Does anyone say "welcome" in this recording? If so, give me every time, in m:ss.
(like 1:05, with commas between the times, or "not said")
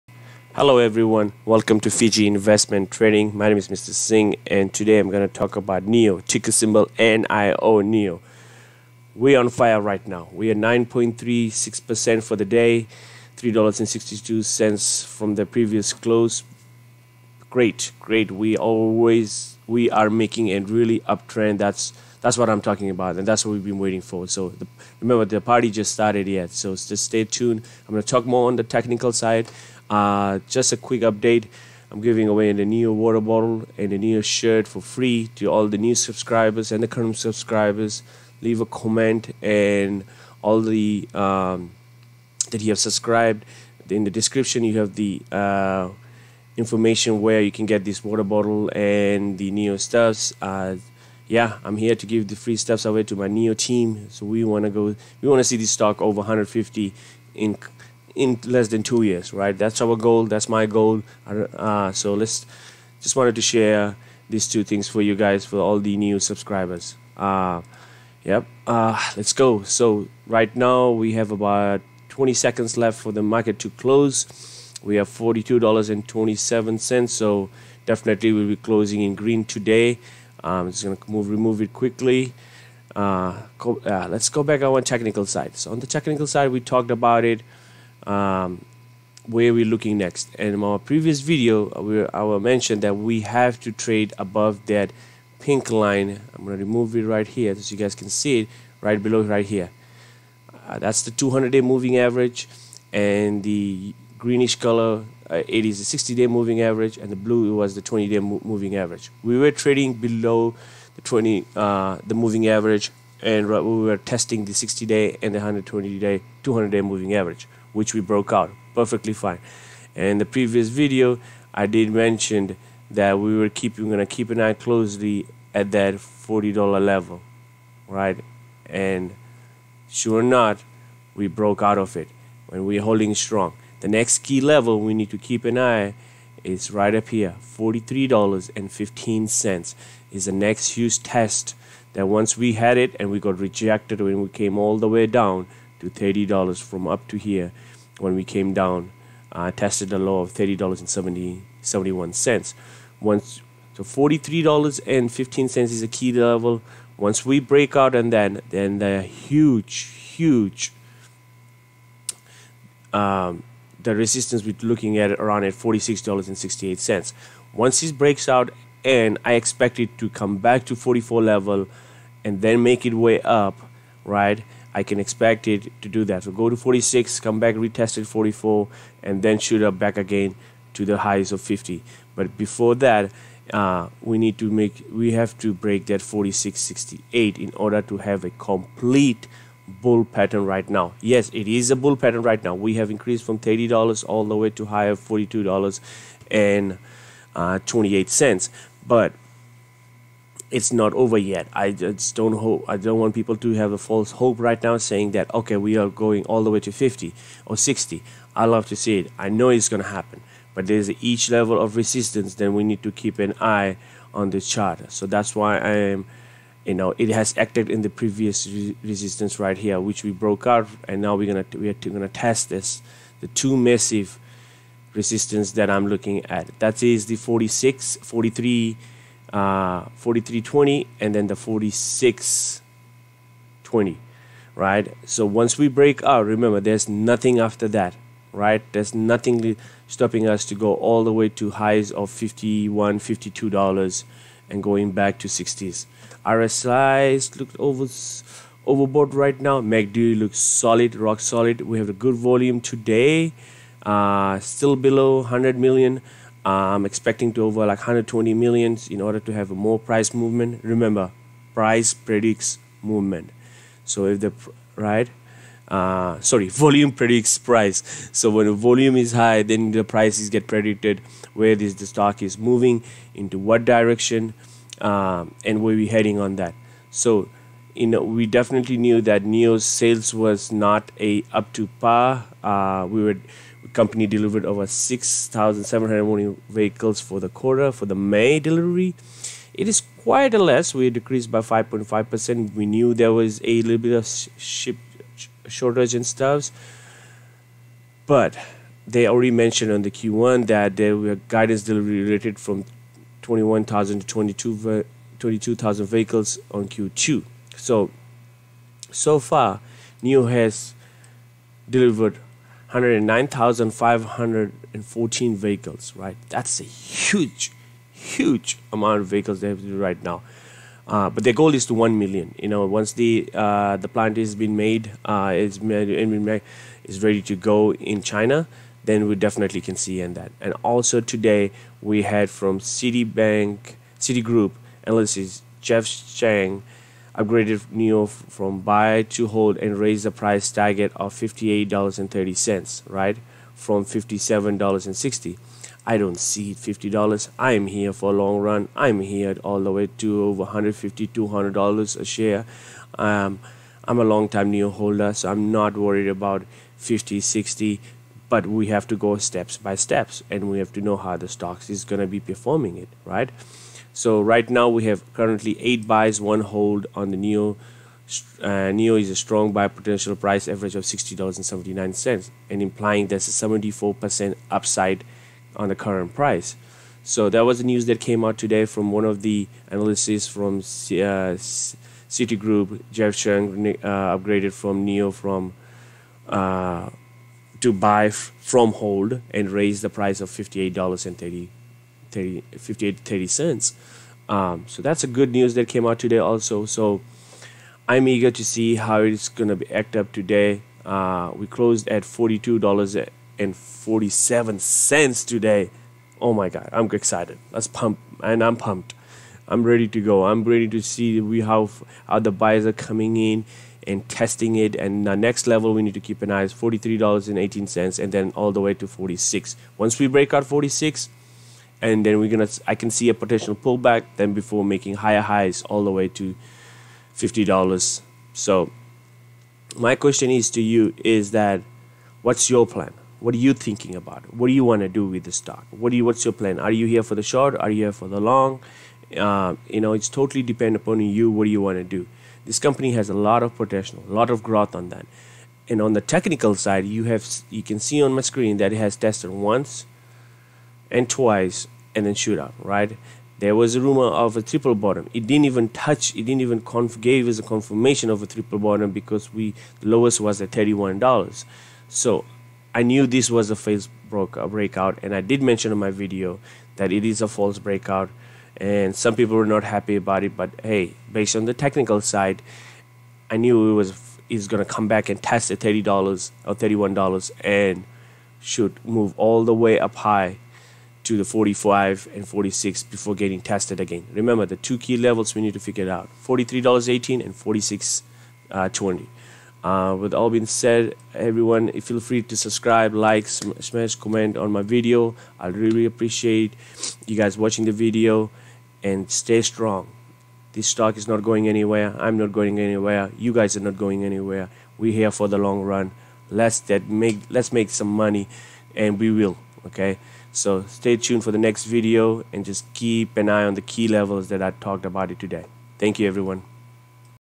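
0:01.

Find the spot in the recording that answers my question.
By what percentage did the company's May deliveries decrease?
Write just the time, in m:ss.
4:51.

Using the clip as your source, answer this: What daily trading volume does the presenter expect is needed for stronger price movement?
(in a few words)
120 million.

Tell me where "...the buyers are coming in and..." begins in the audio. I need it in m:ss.
6:52.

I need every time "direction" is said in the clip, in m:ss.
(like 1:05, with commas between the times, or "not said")
4:33.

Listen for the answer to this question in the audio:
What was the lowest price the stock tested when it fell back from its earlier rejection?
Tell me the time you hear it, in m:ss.
2:30.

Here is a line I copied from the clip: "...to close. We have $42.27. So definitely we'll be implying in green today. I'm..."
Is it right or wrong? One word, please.
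wrong.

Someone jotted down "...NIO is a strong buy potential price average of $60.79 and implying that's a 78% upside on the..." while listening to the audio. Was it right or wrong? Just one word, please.
wrong.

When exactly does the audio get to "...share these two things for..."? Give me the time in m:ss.
1:03.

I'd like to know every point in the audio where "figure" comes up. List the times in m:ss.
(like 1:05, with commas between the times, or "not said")
8:05.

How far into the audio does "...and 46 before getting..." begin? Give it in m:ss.
8:02.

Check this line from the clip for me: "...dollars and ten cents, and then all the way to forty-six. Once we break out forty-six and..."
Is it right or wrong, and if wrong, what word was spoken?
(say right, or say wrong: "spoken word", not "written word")
wrong: "eighteen", not "ten".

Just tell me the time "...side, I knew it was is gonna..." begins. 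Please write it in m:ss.
7:51.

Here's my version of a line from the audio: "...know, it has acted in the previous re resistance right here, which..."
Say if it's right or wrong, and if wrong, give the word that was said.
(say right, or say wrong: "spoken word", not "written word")
right.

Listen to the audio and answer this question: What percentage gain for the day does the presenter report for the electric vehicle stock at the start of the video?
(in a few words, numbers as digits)
9.36%.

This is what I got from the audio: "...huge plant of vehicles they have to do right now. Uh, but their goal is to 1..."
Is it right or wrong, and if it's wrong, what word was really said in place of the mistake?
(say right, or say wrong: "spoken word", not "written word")
wrong: "amount", not "plant".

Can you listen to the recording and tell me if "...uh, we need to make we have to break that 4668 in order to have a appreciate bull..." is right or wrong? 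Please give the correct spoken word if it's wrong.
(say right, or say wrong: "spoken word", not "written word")
wrong: "complete", not "appreciate".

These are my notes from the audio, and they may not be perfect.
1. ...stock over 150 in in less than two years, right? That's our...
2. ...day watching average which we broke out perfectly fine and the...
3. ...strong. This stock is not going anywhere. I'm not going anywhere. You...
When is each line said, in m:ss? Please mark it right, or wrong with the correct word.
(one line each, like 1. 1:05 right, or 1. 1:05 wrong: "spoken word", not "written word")
1. 0:55 right
2. 1:56 wrong: "moving", not "watching"
3. 8:19 right.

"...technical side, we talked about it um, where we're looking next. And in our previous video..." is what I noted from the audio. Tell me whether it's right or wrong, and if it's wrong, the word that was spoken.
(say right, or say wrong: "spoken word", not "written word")
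right.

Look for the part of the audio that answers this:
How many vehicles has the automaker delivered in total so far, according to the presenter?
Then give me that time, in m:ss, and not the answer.
5:12.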